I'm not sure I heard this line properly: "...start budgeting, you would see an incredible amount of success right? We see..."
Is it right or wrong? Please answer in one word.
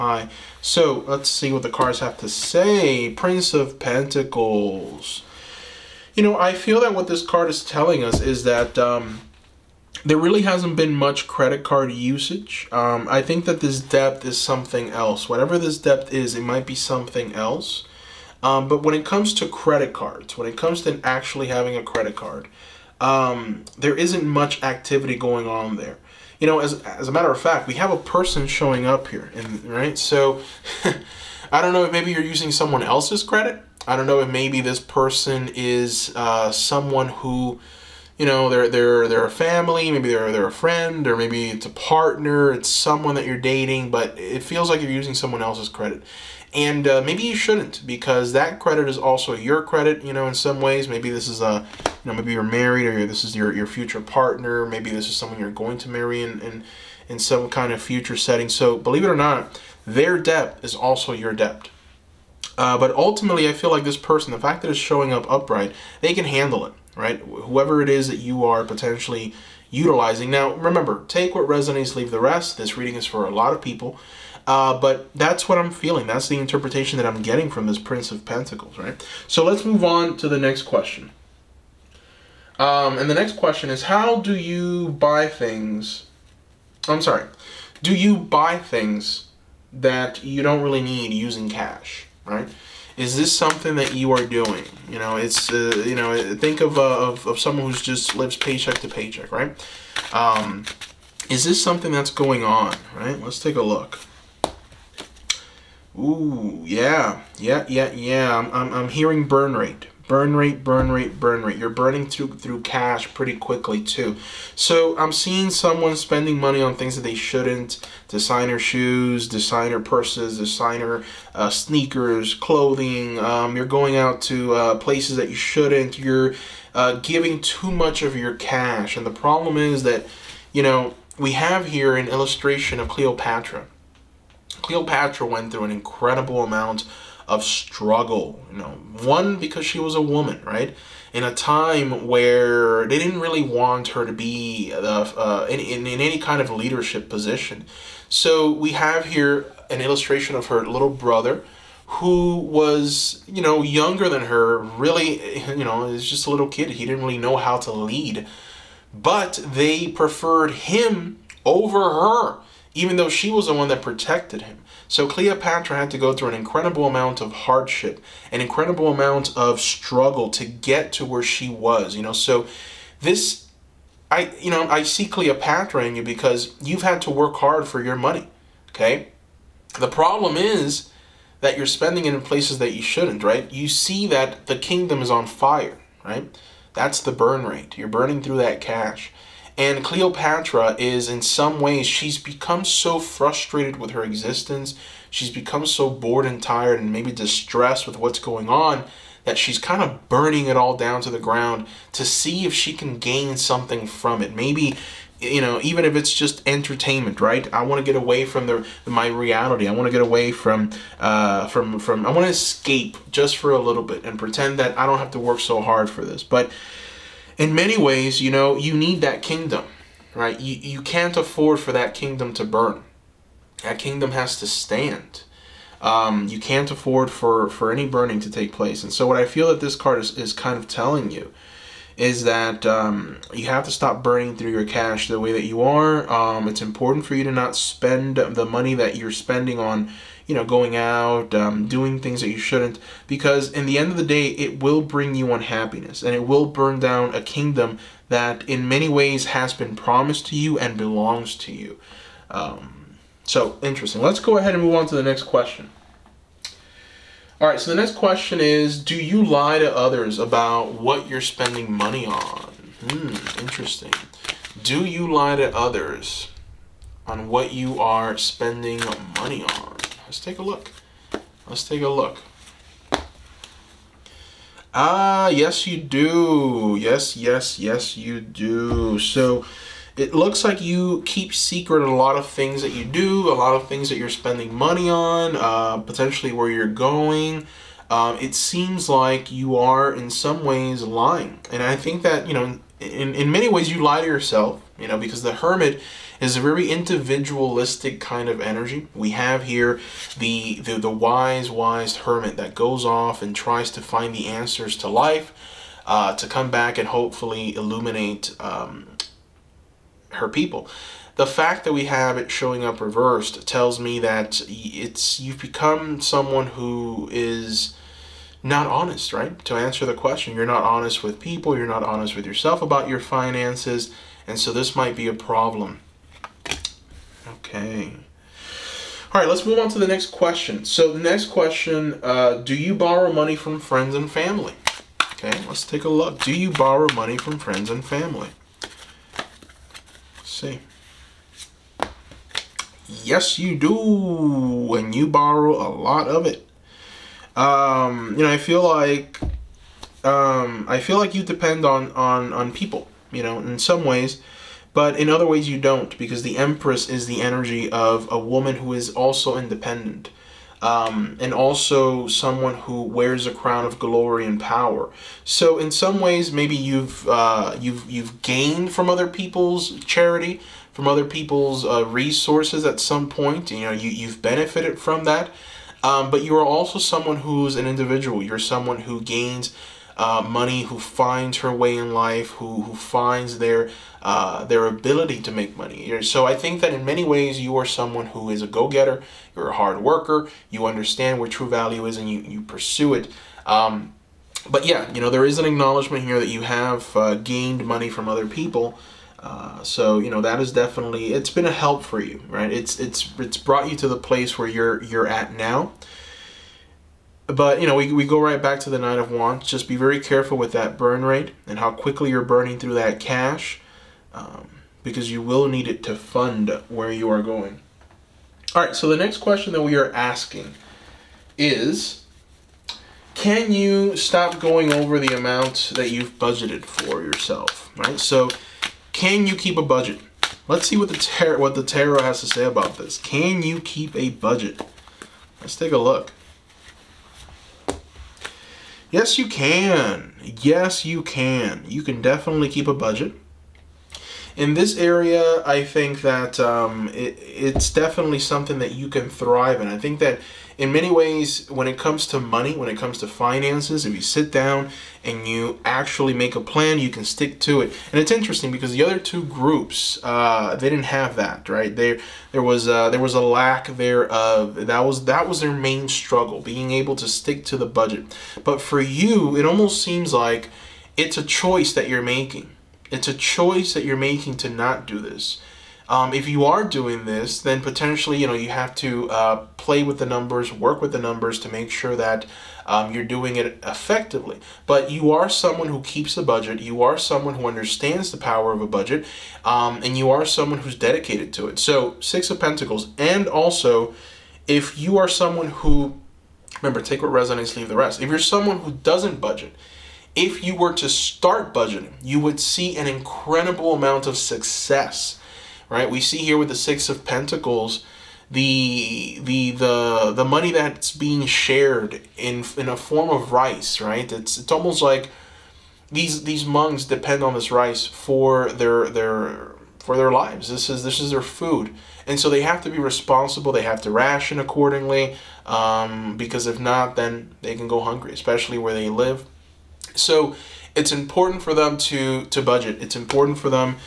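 right.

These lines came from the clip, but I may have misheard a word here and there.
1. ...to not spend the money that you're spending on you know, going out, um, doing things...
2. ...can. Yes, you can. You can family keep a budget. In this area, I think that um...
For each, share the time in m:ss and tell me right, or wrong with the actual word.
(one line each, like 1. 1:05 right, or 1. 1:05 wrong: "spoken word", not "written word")
1. 3:57 right
2. 7:19 wrong: "definitely", not "family".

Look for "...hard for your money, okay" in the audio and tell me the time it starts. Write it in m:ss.
2:57.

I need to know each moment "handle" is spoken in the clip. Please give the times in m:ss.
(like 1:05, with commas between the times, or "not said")
1:06.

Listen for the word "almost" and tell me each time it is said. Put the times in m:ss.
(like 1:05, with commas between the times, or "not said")
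7:49, 8:34.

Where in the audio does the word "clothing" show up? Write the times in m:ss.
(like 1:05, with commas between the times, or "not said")
2:02.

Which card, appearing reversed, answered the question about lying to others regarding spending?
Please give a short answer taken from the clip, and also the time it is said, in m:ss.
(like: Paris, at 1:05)
The Hermit, at 4:55.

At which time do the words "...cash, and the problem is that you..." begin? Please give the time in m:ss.
2:08.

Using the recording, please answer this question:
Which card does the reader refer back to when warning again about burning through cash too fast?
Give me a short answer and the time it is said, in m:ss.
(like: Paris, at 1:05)
Nine of Wands, at 6:48.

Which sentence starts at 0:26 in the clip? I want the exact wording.
You know, as, as a matter of fact, we have a person showing up here, and right?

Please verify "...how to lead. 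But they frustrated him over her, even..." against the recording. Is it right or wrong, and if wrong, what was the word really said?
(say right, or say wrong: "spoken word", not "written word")
wrong: "preferred", not "frustrated".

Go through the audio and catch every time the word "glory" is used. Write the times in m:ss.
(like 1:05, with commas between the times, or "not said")
6:03.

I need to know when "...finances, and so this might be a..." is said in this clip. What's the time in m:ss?
5:23.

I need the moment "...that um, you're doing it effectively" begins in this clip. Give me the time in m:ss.
8:01.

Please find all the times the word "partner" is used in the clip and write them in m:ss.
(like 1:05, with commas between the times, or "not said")
0:41, 0:54.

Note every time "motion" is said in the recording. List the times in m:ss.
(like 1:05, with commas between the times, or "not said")
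not said.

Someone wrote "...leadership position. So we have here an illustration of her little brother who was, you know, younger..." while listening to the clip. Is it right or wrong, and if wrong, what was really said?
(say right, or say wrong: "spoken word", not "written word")
right.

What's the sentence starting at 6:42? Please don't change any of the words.
It's it's it's brought you to the place where you're you're at now.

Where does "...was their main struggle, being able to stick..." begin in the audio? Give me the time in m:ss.
7:45.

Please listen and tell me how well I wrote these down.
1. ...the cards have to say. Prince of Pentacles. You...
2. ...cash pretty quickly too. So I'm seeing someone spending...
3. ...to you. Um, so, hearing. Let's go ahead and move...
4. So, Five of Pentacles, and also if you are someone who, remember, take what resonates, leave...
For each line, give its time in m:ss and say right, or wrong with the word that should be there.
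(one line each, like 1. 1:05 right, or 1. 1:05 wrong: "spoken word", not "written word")
1. 0:01 right
2. 1:52 right
3. 4:11 wrong: "interesting", not "hearing"
4. 8:11 wrong: "Six", not "Five".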